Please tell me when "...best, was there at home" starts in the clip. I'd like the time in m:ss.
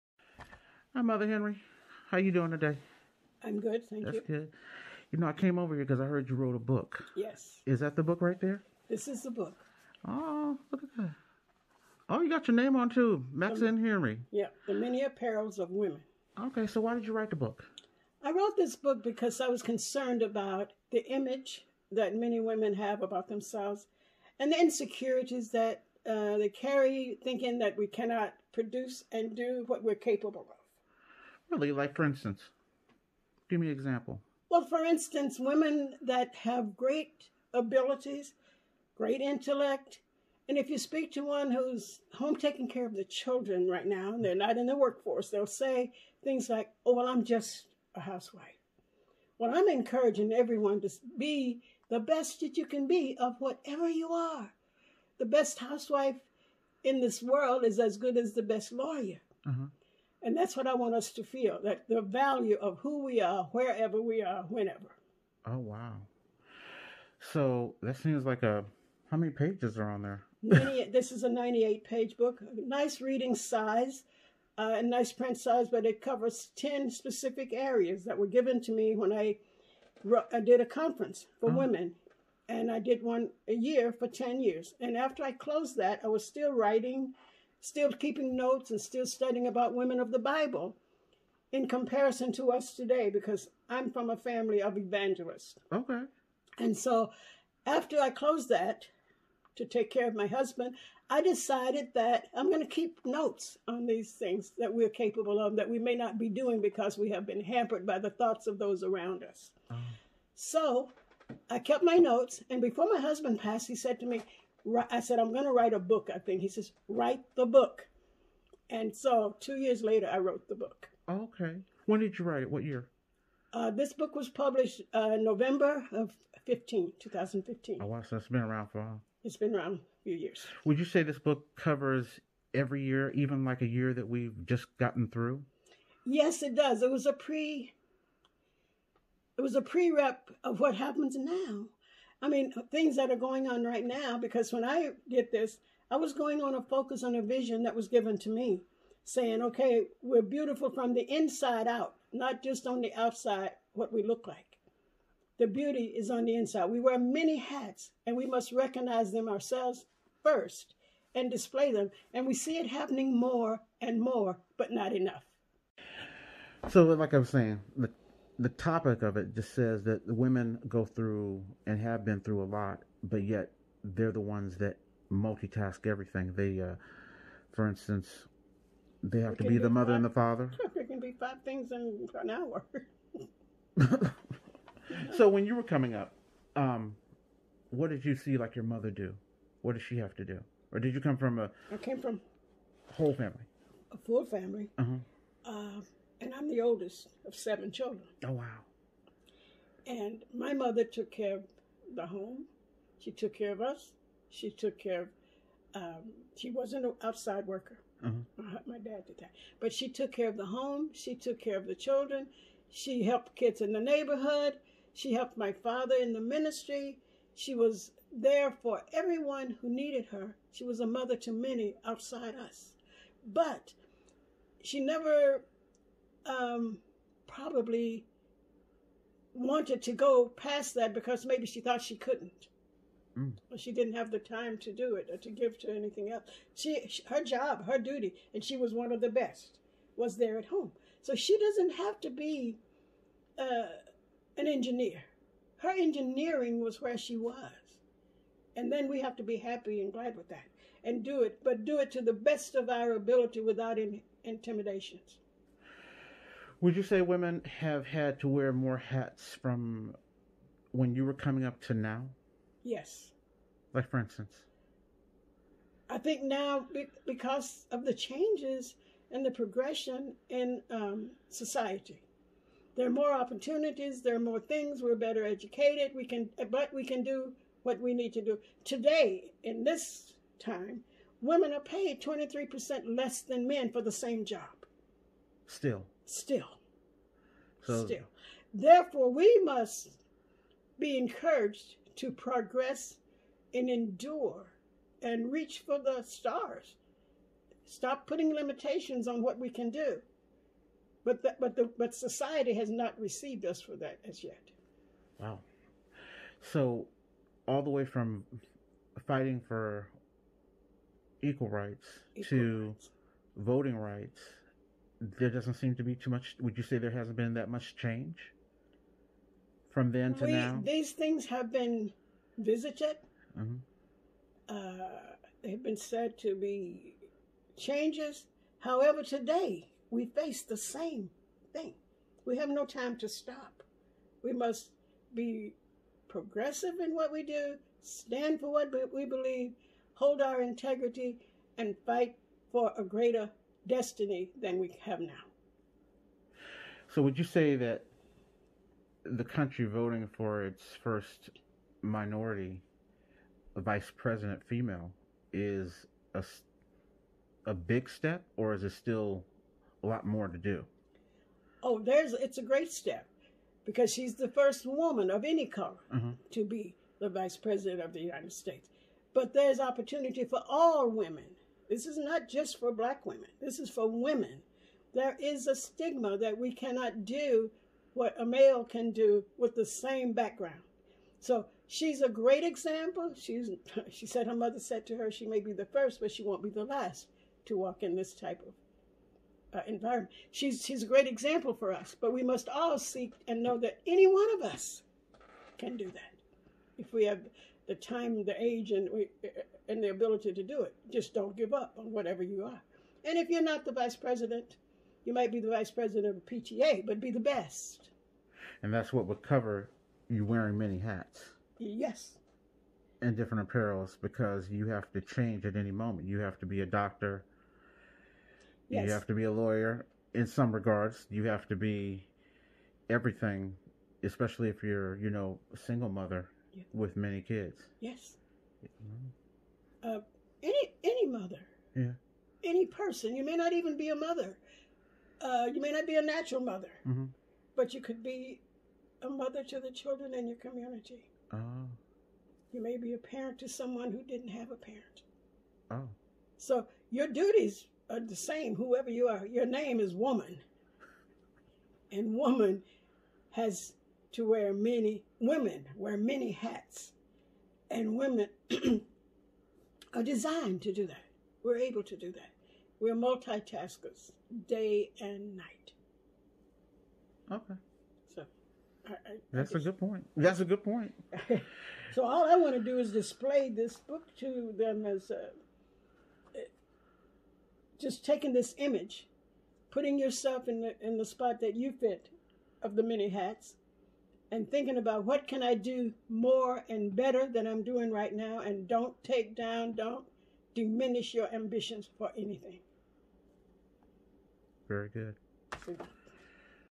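3:59.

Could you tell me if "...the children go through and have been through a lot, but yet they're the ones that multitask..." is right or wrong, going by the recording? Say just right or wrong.
wrong.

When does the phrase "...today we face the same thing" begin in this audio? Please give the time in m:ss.
5:29.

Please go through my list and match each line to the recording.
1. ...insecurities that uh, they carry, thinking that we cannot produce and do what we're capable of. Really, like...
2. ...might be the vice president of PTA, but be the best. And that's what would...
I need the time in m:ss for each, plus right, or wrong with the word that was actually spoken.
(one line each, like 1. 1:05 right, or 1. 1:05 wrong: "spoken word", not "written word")
1. 0:24 right
2. 6:45 right.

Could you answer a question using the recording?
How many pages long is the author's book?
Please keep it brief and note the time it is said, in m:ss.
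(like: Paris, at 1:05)
98, at 1:11.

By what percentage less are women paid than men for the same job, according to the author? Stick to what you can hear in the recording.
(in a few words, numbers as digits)
23%.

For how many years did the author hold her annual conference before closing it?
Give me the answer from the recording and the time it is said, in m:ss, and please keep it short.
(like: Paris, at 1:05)
10, at 1:24.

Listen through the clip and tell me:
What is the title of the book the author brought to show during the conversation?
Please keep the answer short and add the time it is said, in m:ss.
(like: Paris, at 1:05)
The Many Apparels of Women, at 0:14.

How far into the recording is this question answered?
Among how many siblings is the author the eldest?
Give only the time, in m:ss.
3:17.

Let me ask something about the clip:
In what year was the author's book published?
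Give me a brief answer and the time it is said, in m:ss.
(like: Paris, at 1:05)
2015, at 2:06.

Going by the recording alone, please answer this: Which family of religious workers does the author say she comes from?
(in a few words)
evangelists.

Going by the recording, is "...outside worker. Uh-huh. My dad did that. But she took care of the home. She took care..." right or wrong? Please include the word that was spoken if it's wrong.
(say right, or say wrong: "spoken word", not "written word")
right.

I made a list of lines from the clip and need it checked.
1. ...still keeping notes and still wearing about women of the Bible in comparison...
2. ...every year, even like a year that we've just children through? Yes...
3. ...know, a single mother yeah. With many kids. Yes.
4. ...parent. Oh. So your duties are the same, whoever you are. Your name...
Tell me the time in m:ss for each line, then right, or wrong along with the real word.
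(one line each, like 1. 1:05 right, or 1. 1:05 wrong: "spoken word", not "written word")
1. 1:27 wrong: "studying", not "wearing"
2. 2:12 wrong: "gotten", not "children"
3. 7:05 right
4. 7:24 right.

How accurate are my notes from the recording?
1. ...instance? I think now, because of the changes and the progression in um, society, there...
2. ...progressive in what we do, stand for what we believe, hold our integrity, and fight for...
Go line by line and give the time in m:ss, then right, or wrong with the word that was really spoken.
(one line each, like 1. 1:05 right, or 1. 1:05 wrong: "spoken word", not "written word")
1. 4:23 right
2. 5:36 right.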